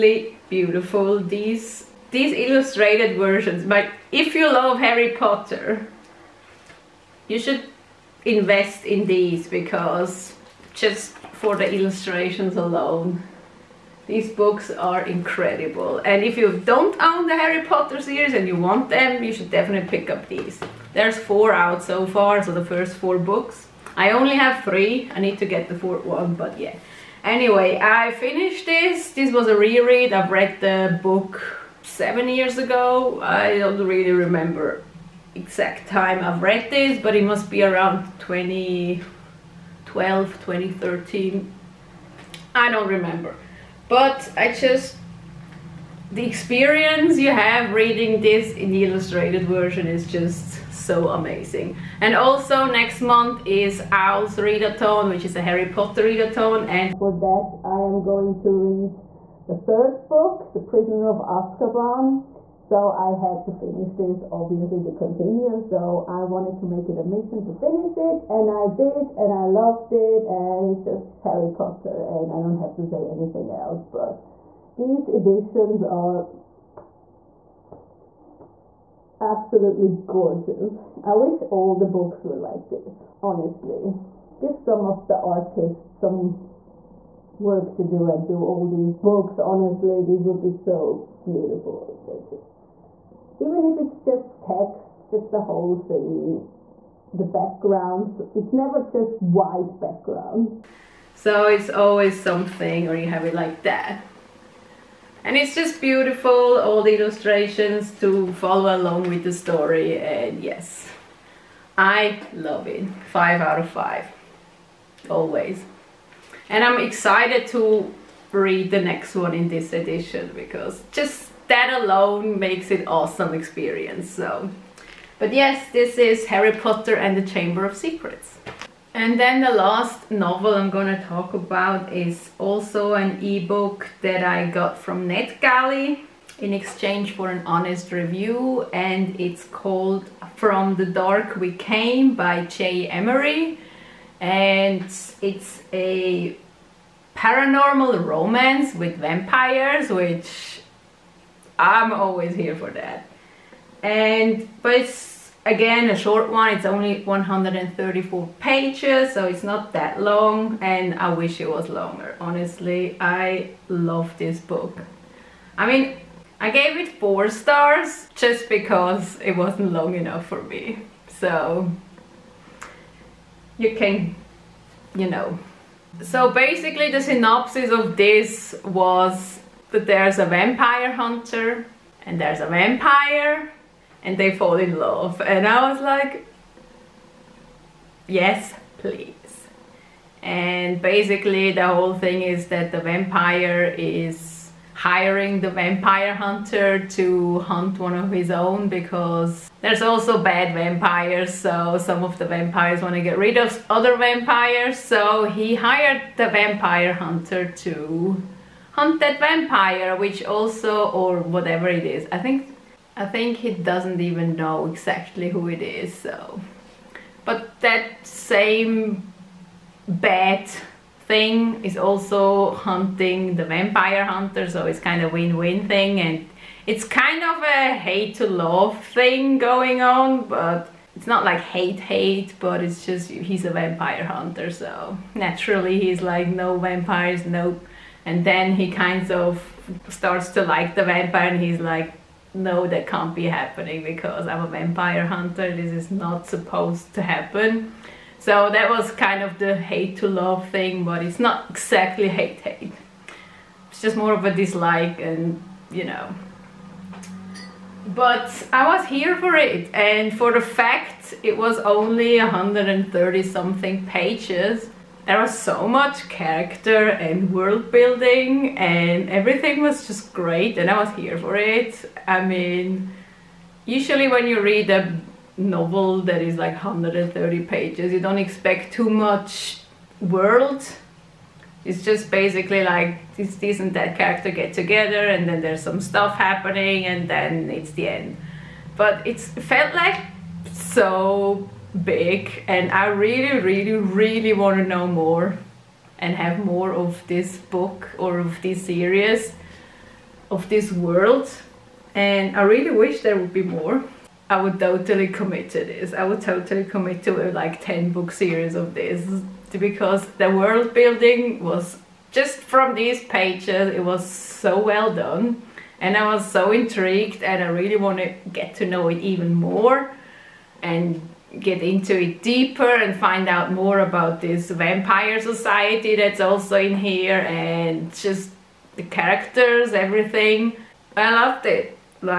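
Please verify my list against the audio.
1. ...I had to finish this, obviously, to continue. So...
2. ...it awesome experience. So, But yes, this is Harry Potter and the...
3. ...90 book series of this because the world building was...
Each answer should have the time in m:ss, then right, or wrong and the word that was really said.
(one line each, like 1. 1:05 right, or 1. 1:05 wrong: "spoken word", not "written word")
1. 1:02 right
2. 2:02 right
3. 5:07 wrong: "10", not "90".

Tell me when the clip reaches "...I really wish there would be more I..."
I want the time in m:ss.
5:02.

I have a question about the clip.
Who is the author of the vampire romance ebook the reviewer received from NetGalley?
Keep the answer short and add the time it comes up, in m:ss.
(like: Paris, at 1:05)
J. Emery, at 2:22.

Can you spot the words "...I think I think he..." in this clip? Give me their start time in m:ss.
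3:32.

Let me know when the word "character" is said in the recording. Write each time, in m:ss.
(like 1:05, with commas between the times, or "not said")
4:26, 4:43, 5:28.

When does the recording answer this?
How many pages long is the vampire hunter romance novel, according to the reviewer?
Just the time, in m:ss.
2:37.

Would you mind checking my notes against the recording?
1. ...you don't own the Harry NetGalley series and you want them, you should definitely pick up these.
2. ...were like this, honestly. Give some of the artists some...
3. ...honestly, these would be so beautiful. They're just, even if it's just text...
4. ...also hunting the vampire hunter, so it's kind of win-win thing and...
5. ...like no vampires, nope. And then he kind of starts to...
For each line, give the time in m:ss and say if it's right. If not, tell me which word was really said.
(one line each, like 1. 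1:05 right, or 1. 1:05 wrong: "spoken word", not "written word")
1. 0:16 wrong: "Potter", not "NetGalley"
2. 1:22 right
3. 1:29 right
4. 3:41 right
5. 3:56 right.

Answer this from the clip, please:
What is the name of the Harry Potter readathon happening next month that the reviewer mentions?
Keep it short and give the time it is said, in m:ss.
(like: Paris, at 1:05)
Owl's readathon, at 0:53.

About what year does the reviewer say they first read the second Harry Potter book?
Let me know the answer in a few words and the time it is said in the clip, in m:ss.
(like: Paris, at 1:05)
2012, at 0:38.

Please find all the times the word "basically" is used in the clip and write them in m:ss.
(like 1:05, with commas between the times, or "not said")
2:56, 3:10, 4:42.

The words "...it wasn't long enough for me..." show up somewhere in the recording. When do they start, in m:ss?
2:49.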